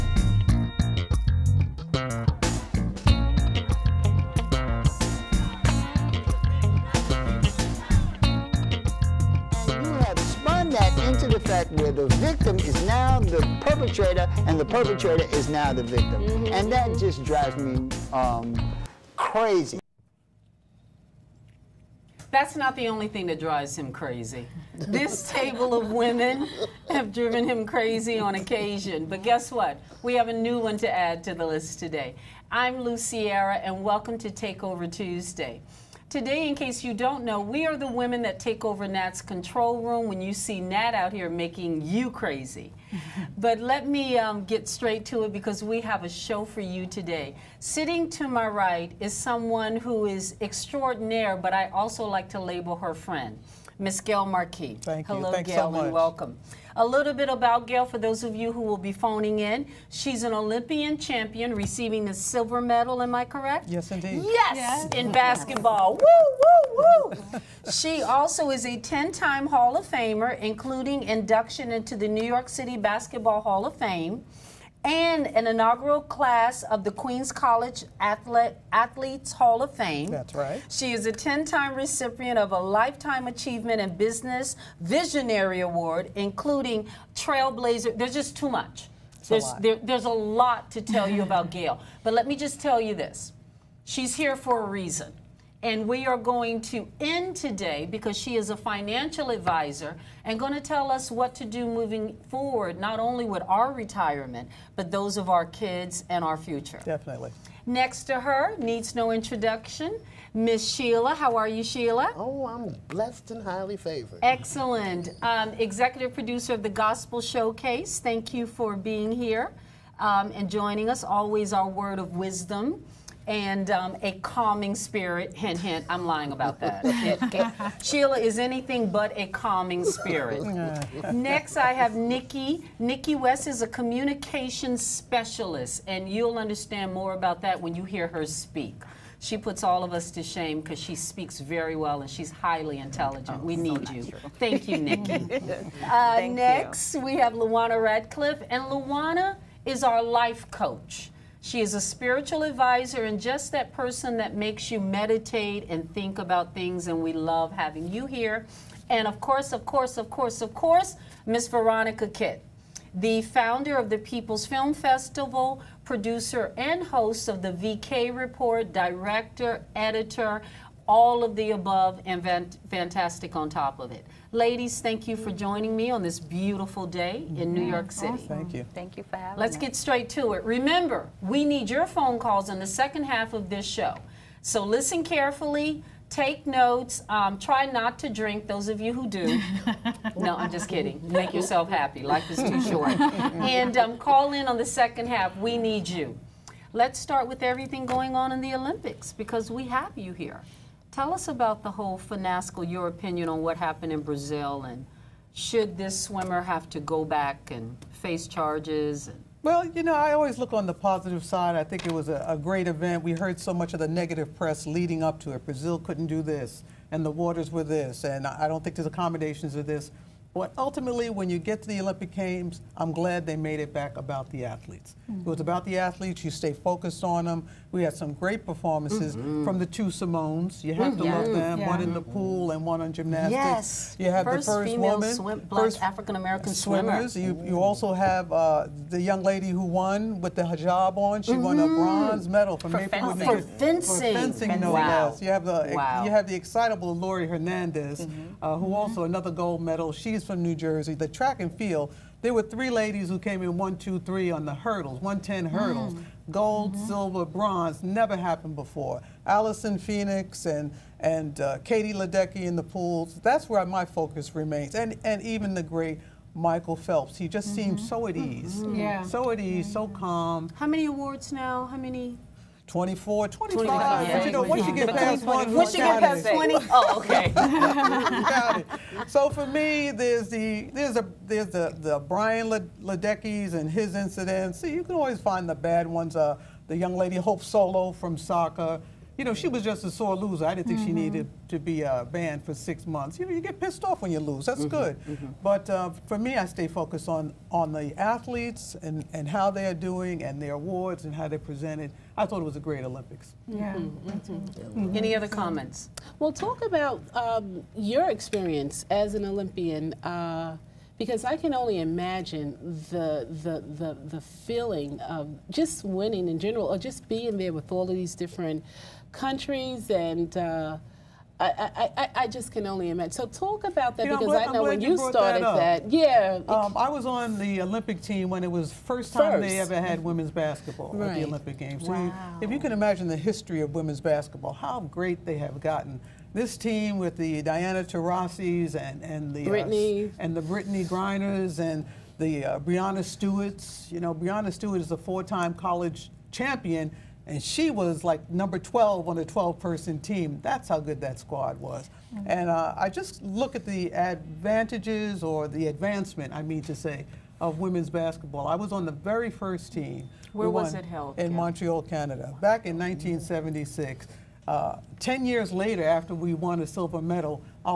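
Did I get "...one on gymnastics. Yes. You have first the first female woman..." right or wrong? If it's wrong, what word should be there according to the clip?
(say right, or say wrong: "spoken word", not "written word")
right.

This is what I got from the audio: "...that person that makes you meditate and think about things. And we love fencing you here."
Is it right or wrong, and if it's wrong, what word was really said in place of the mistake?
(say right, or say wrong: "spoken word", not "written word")
wrong: "having", not "fencing".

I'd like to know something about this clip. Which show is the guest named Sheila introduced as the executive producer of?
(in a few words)
Gospel Showcase.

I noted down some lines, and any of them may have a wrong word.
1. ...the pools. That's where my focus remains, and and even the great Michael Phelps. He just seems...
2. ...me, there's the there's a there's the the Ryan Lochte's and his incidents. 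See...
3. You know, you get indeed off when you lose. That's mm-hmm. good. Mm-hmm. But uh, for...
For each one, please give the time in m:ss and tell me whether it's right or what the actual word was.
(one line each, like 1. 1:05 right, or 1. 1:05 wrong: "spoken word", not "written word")
1. 4:22 right
2. 4:39 right
3. 4:53 wrong: "pissed", not "indeed".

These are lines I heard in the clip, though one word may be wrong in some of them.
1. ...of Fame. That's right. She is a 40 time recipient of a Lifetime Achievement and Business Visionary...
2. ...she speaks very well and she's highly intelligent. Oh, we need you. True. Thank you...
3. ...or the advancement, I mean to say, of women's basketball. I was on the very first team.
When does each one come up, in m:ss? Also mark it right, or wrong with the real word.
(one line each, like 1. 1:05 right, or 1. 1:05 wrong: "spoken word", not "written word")
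1. 1:19 wrong: "10", not "40"
2. 2:20 right
3. 5:55 right.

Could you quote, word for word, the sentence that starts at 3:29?
And- well, you know, I always look on the positive side.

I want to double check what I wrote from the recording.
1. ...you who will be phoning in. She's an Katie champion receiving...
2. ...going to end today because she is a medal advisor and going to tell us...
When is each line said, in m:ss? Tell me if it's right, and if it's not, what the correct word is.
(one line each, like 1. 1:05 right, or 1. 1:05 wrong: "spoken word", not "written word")
1. 0:58 wrong: "Olympian", not "Katie"
2. 1:36 wrong: "financial", not "medal".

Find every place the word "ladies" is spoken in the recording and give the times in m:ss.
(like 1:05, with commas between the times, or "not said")
2:54, 4:12.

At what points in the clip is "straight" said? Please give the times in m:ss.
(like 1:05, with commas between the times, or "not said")
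0:44, 2:59.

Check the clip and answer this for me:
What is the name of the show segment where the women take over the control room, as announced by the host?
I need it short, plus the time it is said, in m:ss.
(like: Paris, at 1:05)
Takeover Tuesday, at 0:34.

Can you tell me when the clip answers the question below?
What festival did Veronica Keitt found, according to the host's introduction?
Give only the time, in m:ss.
2:43.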